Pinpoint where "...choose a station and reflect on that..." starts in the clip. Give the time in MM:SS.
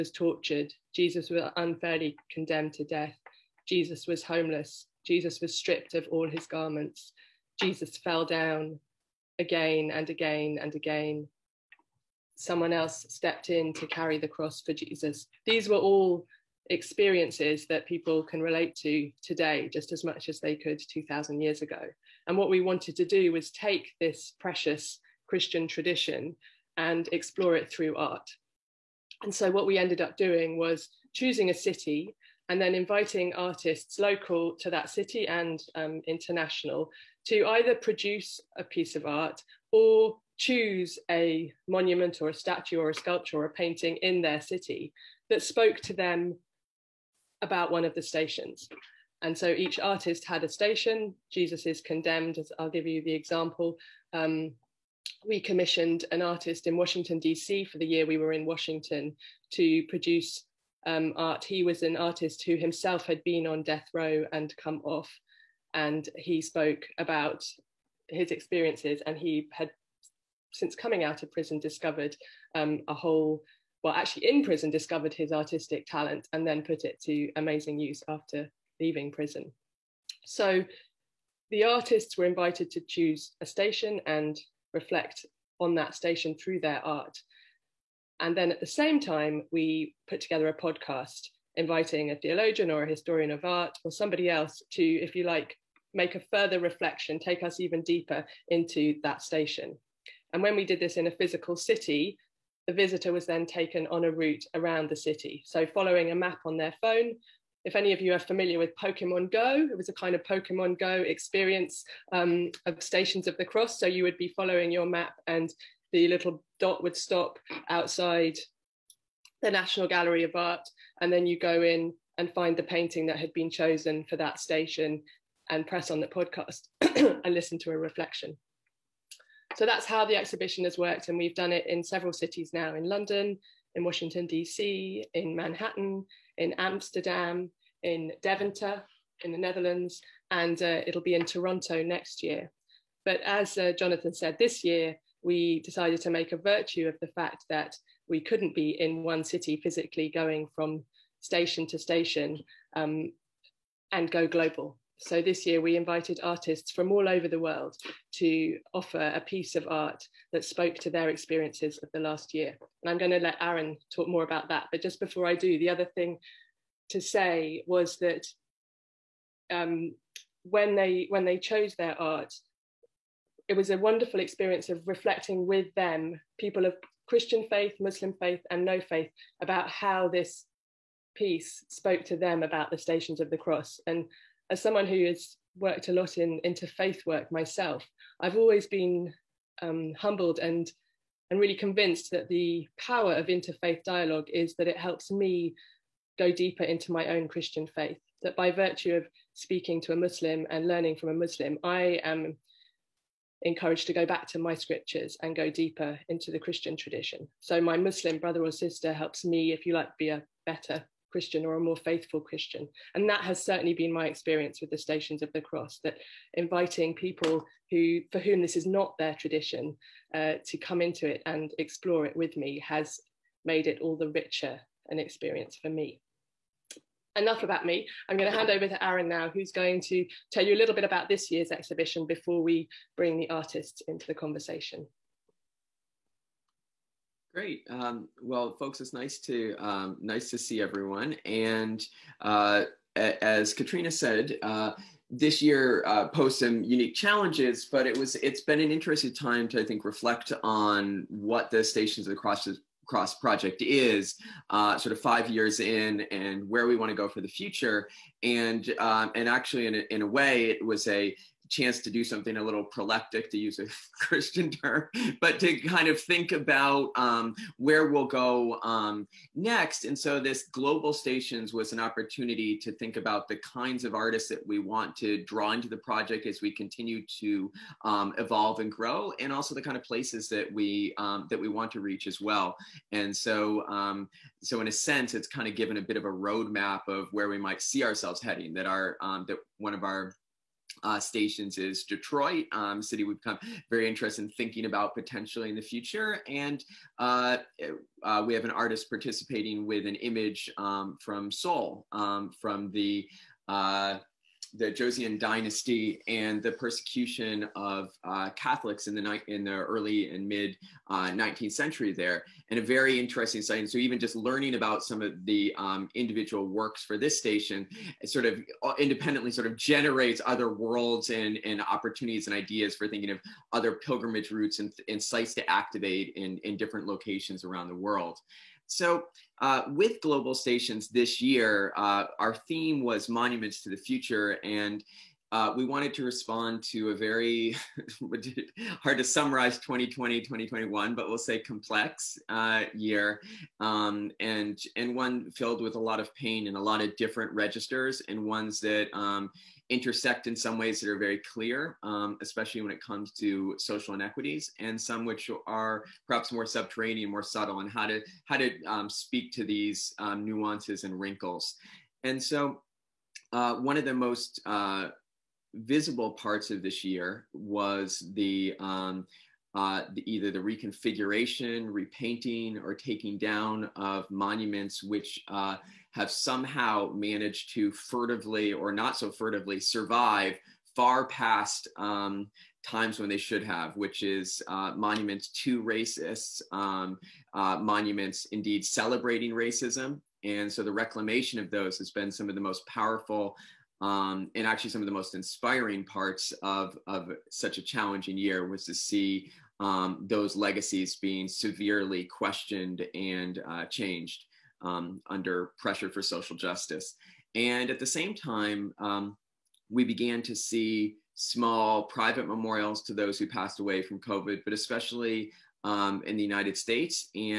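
01:22.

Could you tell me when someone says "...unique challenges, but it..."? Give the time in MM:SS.
04:06.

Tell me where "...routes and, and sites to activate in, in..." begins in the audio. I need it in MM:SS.
05:24.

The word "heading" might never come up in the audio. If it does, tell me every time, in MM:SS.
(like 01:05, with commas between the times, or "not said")
04:48.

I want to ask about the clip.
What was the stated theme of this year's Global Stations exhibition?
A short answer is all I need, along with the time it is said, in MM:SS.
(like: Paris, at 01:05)
Monuments to the Future, at 05:33.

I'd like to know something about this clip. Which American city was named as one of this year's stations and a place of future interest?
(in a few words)
Detroit.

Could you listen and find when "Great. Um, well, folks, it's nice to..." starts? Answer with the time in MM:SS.
03:57.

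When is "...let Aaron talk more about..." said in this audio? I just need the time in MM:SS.
02:43.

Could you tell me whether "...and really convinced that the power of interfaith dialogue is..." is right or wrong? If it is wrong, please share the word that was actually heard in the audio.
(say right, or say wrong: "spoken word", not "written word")
right.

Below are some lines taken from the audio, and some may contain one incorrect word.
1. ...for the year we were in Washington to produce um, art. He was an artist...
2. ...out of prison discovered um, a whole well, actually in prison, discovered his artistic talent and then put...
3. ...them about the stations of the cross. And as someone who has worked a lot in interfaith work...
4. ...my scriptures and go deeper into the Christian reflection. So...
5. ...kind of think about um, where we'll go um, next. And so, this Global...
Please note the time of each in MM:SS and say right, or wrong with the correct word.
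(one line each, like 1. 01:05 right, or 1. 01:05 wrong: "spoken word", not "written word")
1. 00:57 right
2. 01:11 right
3. 03:02 right
4. 03:24 wrong: "tradition", not "reflection"
5. 04:25 right.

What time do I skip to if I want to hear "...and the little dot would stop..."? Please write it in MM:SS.
01:55.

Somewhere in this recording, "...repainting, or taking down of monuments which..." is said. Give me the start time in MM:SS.
06:11.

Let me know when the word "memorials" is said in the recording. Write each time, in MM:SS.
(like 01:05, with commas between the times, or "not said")
06:52.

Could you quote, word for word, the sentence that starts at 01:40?
And when we did this in a physical city, the visitor was then taken on a route around the city.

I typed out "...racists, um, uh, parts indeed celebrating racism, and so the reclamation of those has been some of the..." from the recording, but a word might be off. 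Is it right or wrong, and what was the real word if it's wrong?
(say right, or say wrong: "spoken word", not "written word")
wrong: "monuments", not "parts".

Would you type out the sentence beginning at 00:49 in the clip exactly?
And so each artist had a station.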